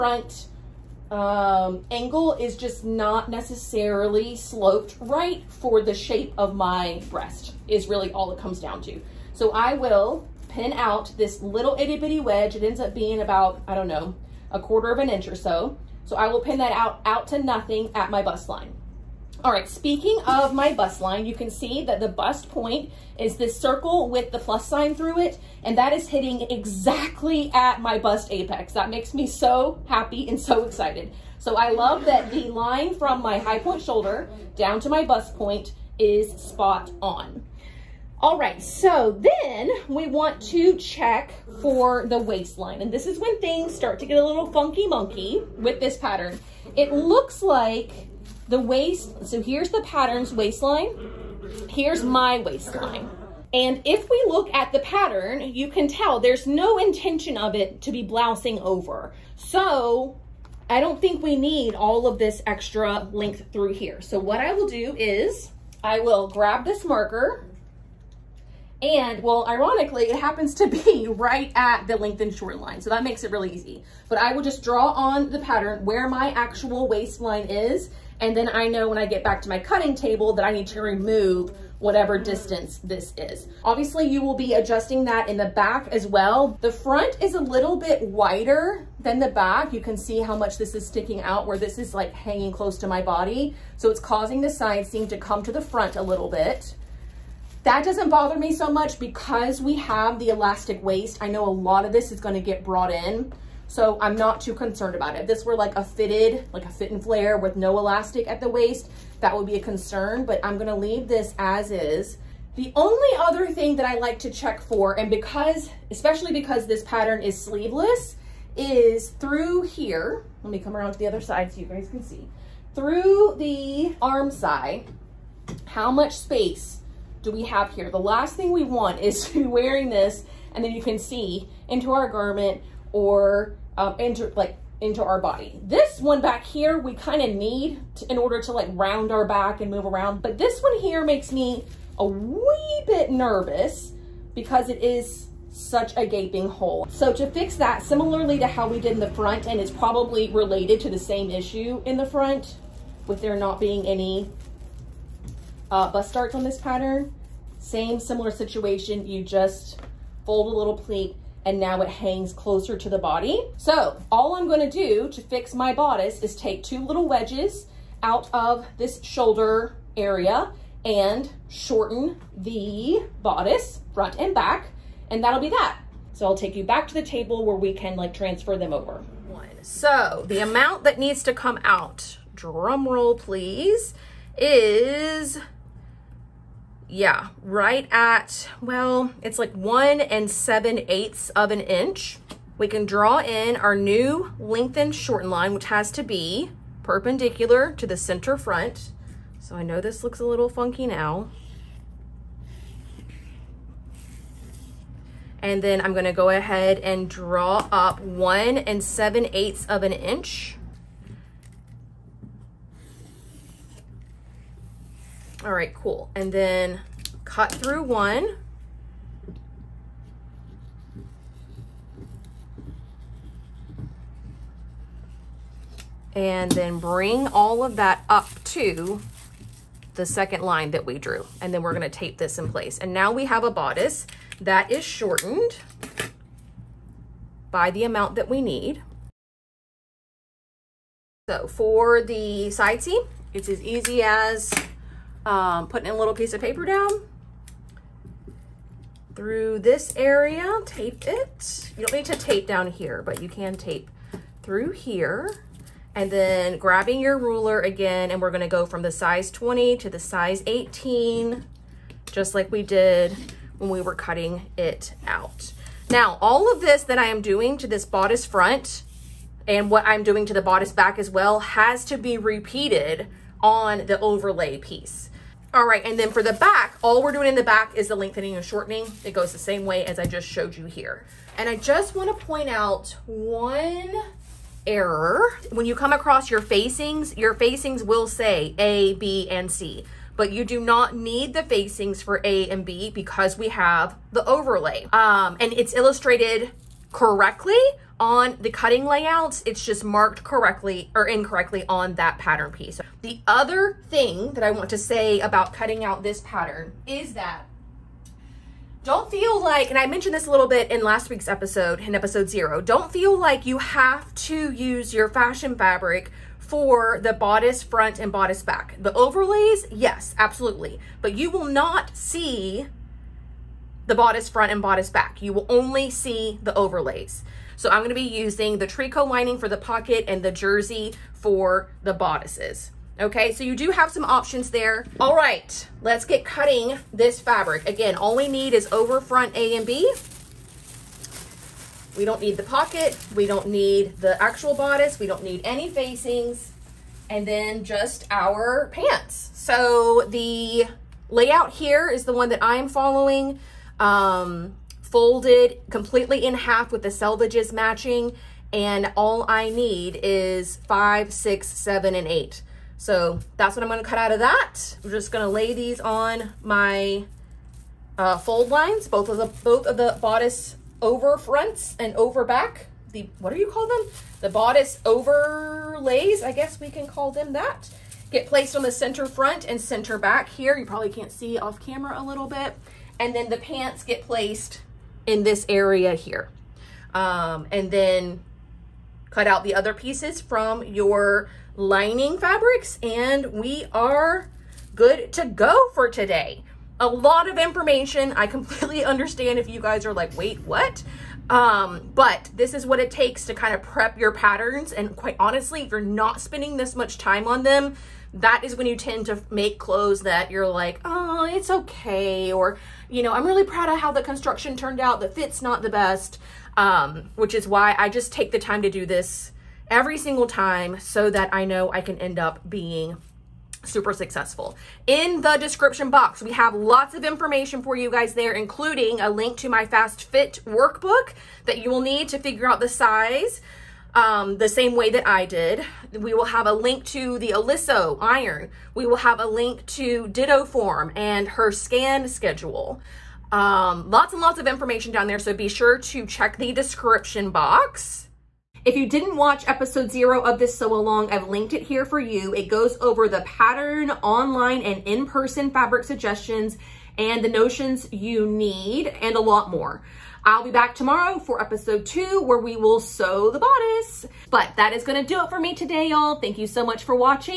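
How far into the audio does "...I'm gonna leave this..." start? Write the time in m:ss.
1:50.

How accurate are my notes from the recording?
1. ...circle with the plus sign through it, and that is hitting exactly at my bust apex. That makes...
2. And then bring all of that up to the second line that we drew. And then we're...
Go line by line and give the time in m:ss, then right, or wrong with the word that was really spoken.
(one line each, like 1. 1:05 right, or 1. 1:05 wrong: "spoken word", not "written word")
1. 0:23 right
2. 3:46 right.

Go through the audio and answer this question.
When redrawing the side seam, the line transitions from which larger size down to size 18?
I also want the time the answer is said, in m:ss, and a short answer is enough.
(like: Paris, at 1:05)
20, at 4:18.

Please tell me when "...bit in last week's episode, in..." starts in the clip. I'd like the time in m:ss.
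5:10.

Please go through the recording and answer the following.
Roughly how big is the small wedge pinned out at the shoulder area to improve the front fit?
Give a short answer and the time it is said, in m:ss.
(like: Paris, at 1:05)
a quarter of an inch, at 0:14.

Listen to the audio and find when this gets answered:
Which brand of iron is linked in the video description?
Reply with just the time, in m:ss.
7:17.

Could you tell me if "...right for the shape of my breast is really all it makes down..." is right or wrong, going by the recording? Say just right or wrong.
wrong.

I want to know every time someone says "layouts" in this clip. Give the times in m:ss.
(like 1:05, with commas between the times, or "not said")
4:58, 5:51.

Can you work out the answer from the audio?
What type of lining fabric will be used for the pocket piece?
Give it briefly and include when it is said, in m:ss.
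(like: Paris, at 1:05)
tricot, at 5:28.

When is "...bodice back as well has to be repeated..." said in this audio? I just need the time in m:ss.
4:30.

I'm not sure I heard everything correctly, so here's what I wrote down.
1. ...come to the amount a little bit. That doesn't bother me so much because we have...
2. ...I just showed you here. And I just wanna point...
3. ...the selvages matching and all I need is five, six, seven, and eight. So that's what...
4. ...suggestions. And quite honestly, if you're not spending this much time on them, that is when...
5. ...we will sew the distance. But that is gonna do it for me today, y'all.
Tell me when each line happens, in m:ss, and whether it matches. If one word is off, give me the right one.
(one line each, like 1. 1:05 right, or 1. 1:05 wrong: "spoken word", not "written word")
1. 1:35 wrong: "front", not "amount"
2. 4:39 right
3. 5:56 right
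4. 6:44 wrong: "patterns", not "suggestions"
5. 7:42 wrong: "bodice", not "distance".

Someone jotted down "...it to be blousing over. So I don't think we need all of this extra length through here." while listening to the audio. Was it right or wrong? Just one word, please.
right.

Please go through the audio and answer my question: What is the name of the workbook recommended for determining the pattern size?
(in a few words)
Fast Fit workbook.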